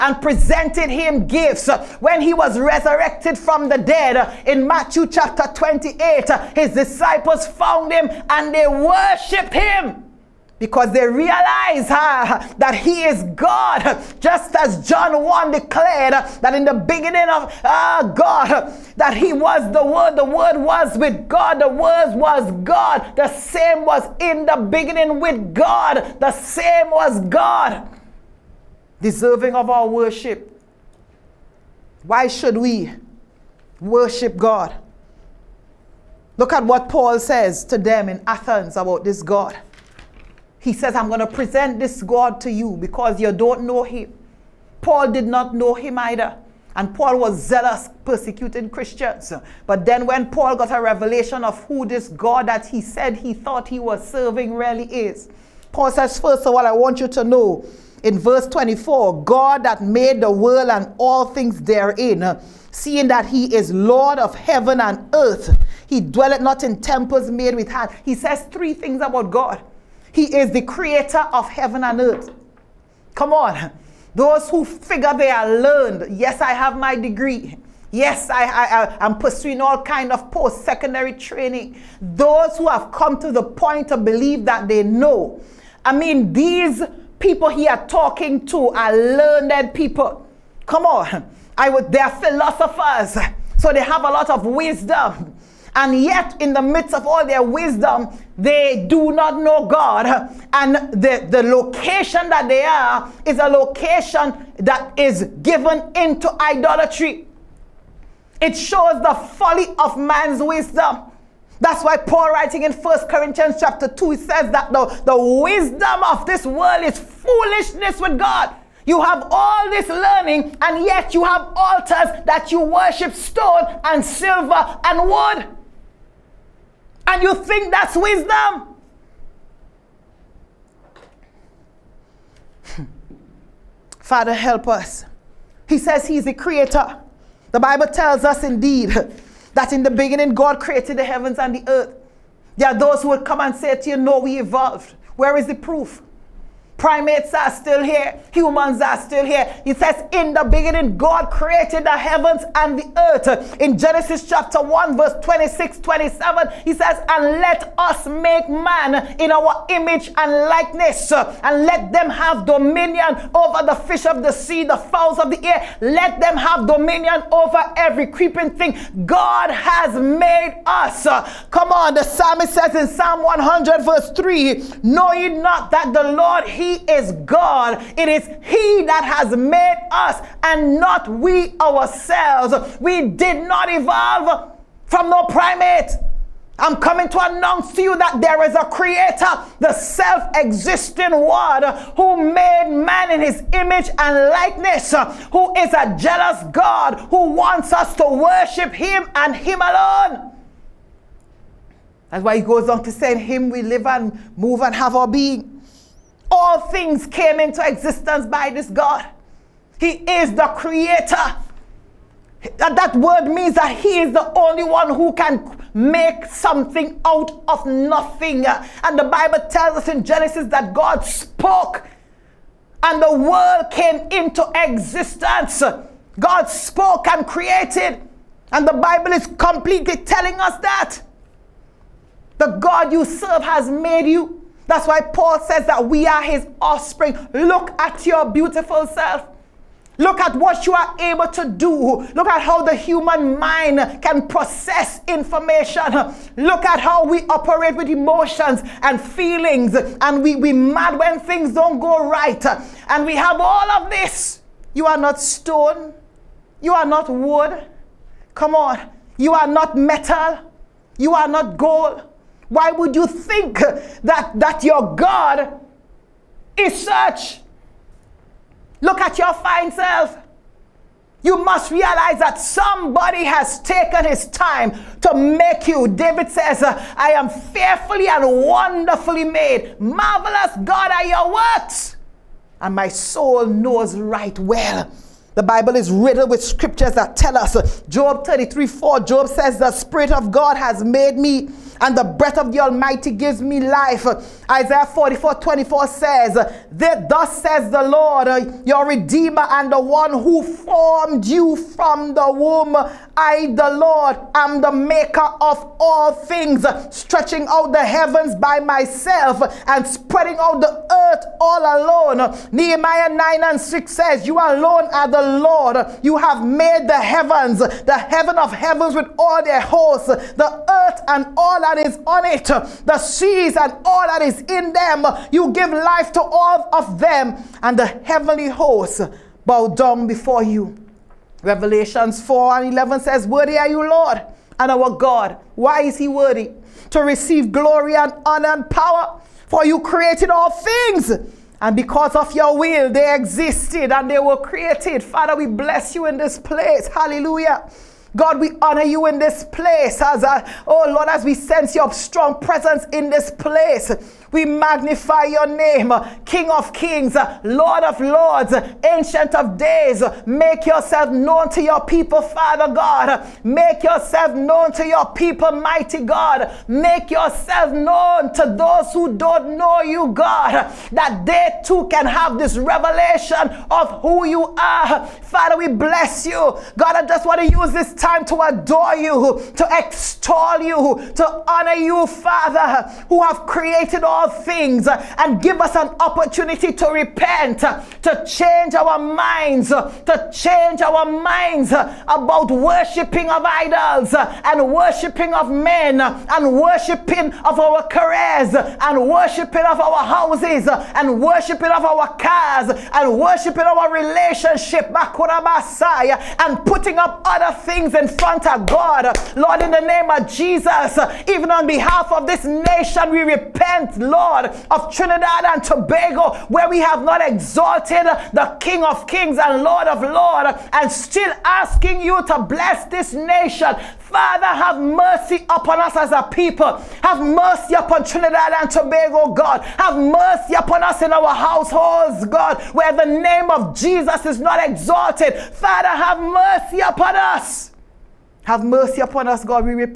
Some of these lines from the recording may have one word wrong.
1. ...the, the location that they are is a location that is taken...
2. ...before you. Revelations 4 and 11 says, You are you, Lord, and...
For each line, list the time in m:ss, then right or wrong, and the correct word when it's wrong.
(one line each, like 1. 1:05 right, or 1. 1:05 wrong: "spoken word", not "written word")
1. 1:40 wrong: "given", not "taken"
2. 5:30 wrong: "Worthy", not "You".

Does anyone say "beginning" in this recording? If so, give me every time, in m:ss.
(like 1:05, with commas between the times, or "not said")
0:16, 0:24, 2:19, 2:30.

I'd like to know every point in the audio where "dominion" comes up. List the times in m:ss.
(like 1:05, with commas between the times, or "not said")
2:42, 2:46.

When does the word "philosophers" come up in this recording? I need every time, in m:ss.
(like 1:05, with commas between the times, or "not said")
1:32.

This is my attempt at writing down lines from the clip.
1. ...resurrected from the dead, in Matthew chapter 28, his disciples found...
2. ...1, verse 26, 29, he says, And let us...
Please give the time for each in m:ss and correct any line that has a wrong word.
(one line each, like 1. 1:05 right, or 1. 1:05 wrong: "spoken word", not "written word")
1. 0:02 right
2. 2:34 wrong: "27", not "29".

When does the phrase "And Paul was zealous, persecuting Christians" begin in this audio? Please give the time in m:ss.
0:46.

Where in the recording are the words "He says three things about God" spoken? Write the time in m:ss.
1:08.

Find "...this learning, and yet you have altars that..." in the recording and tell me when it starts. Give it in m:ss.
1:59.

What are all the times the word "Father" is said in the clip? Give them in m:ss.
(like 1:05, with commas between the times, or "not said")
2:13, 5:45, 6:02, 6:15, 6:22, 7:03, 7:15.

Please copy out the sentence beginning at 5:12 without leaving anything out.
Nehemiah 9 and 6 says, You alone are the Lord.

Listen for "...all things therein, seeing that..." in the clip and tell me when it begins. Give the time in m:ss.
1:00.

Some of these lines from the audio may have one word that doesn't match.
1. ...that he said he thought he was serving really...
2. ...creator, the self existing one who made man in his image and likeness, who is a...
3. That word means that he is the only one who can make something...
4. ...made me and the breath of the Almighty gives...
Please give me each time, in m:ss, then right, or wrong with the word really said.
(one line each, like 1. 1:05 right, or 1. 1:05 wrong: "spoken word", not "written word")
1. 0:52 right
2. 3:08 right
3. 3:32 right
4. 4:50 right.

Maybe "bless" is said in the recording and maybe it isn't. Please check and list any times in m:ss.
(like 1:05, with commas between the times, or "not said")
5:45, 6:15, 7:02.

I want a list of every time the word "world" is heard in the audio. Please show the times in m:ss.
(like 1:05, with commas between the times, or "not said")
1:00, 1:56, 3:43.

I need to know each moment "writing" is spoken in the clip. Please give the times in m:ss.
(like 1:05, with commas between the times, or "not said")
1:52.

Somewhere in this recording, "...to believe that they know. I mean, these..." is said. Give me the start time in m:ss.
1:23.